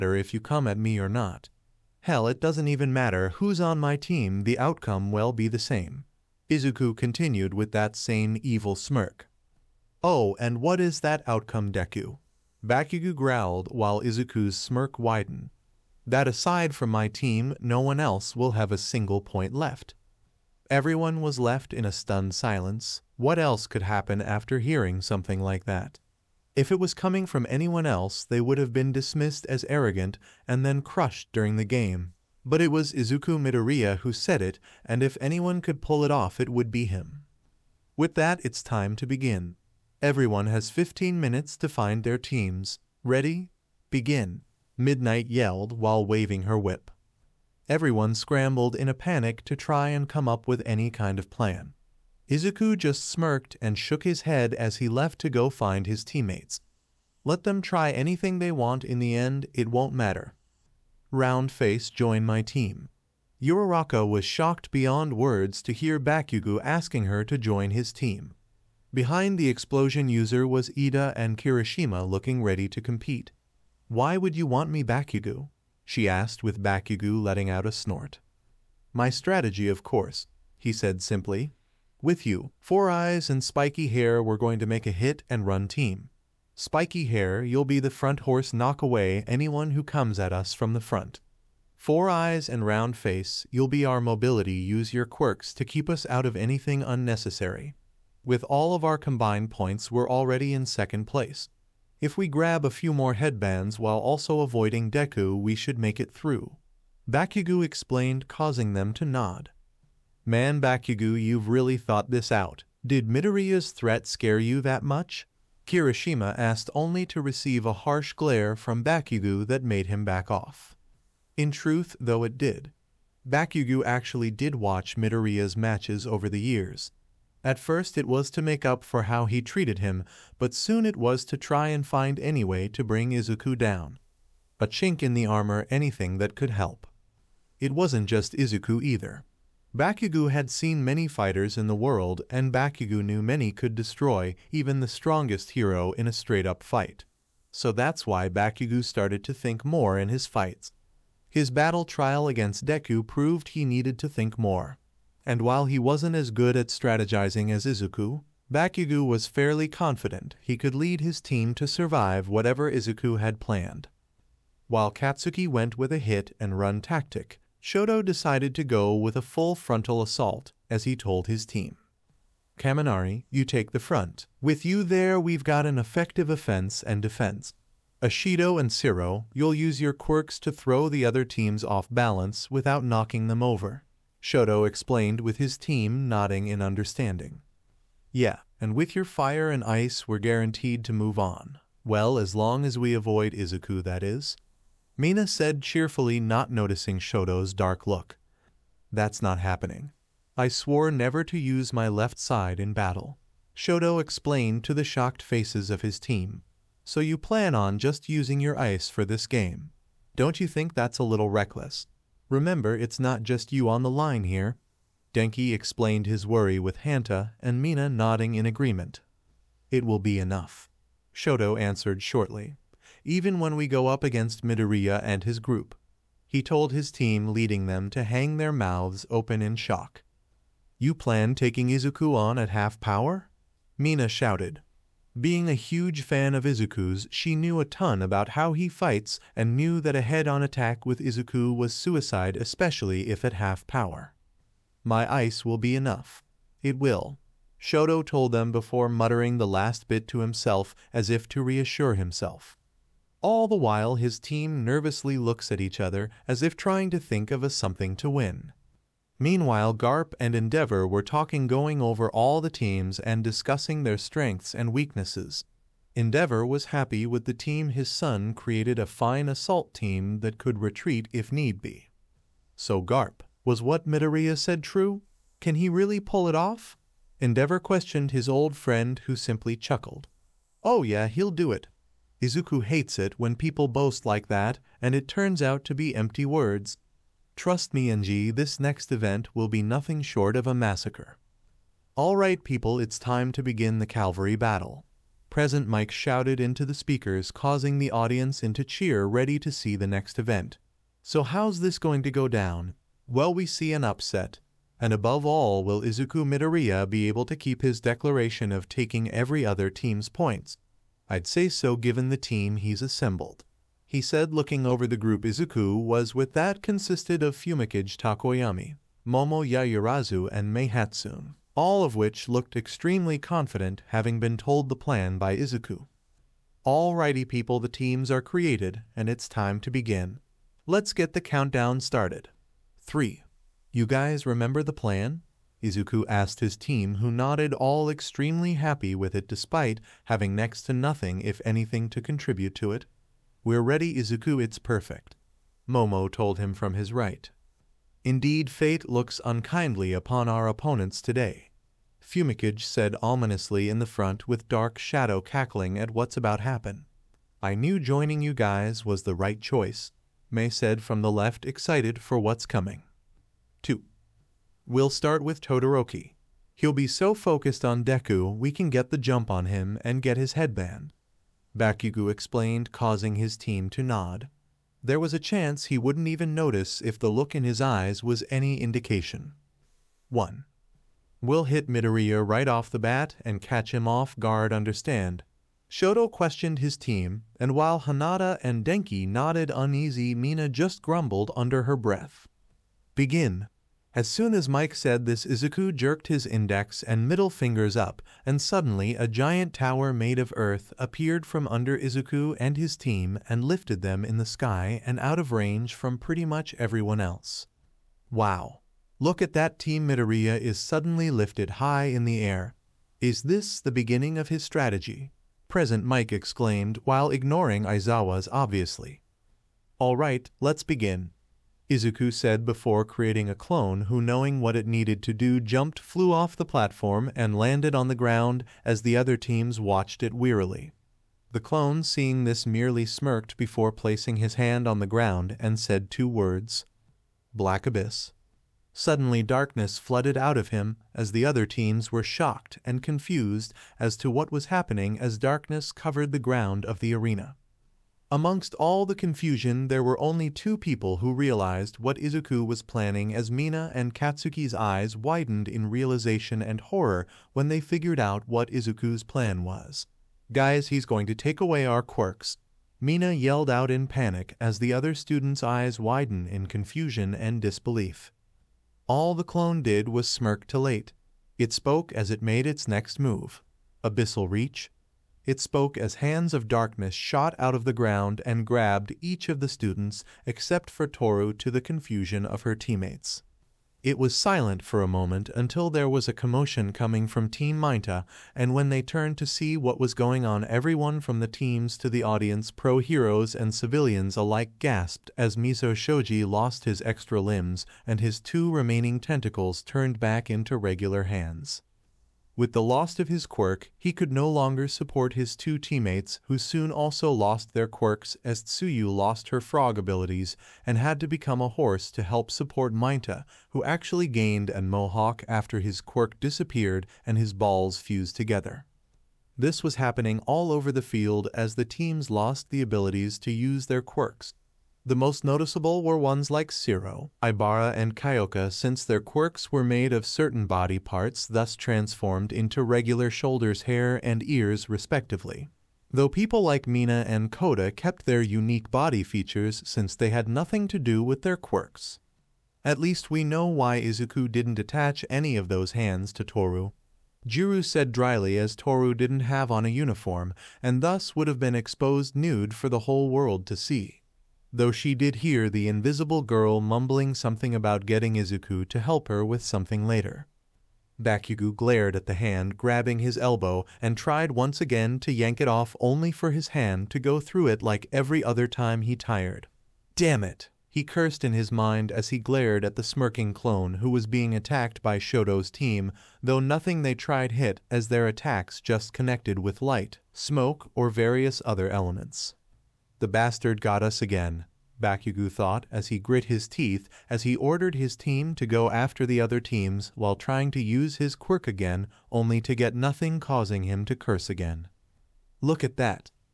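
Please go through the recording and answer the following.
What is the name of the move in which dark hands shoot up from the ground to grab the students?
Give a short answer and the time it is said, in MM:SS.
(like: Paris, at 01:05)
Abyssal Reach, at 07:53.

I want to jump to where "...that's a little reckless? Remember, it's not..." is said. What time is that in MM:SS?
03:30.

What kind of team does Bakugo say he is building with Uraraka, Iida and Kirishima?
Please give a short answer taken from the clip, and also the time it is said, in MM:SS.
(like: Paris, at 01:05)
Hit and run, at 01:24.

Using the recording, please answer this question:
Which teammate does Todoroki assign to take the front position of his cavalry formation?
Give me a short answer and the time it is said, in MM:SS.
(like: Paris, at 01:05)
Kaminari, at 02:52.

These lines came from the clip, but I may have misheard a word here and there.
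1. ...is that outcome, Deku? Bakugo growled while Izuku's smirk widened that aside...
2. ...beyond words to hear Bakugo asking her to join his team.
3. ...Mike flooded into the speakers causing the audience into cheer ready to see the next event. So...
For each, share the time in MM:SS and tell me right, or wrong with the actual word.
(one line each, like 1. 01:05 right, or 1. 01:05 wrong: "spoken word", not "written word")
1. 00:10 right
2. 01:04 right
3. 04:55 wrong: "shouted", not "flooded".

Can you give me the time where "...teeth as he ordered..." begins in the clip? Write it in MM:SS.
09:46.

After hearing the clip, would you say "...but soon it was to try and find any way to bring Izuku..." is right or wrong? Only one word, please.
right.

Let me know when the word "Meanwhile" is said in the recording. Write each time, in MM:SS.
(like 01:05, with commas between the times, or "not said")
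04:19.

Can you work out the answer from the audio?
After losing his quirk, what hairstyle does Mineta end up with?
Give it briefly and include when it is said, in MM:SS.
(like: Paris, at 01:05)
A mohawk, at 08:34.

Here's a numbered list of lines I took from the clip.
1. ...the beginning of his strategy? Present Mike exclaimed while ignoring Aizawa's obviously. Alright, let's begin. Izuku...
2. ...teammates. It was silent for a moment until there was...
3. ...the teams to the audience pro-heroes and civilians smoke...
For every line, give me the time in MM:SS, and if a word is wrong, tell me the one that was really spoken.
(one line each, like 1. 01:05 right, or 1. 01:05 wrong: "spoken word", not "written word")
1. 06:53 right
2. 08:02 right
3. 08:11 wrong: "alike", not "smoke".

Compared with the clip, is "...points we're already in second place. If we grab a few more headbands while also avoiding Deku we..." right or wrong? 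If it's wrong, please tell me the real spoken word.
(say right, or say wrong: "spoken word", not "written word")
right.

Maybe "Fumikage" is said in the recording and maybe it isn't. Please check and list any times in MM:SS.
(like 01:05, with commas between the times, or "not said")
05:17, 05:51.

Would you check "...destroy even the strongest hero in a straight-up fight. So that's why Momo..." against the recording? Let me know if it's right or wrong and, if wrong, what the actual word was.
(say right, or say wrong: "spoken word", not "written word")
wrong: "Bakugo", not "Momo".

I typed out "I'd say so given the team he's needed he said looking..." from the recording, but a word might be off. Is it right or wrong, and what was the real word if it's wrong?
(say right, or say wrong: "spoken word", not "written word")
wrong: "assembled", not "needed".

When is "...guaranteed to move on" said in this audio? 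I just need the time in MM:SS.
03:10.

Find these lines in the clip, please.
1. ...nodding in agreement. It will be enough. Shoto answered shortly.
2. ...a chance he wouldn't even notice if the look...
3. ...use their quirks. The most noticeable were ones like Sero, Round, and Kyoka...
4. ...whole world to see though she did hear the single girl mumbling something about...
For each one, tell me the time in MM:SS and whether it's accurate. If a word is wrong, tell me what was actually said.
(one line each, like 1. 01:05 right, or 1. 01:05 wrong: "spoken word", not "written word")
1. 03:37 right
2. 06:15 right
3. 08:43 wrong: "Ibara", not "Round"
4. 09:12 wrong: "invisible", not "single".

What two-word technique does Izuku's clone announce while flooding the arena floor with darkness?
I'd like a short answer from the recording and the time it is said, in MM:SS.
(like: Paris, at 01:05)
Black Abyss, at 07:17.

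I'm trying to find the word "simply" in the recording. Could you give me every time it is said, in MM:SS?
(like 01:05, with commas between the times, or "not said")
01:21, 04:39.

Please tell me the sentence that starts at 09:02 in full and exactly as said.
At least we know why Izuku didn't attach any of those hands to Toru.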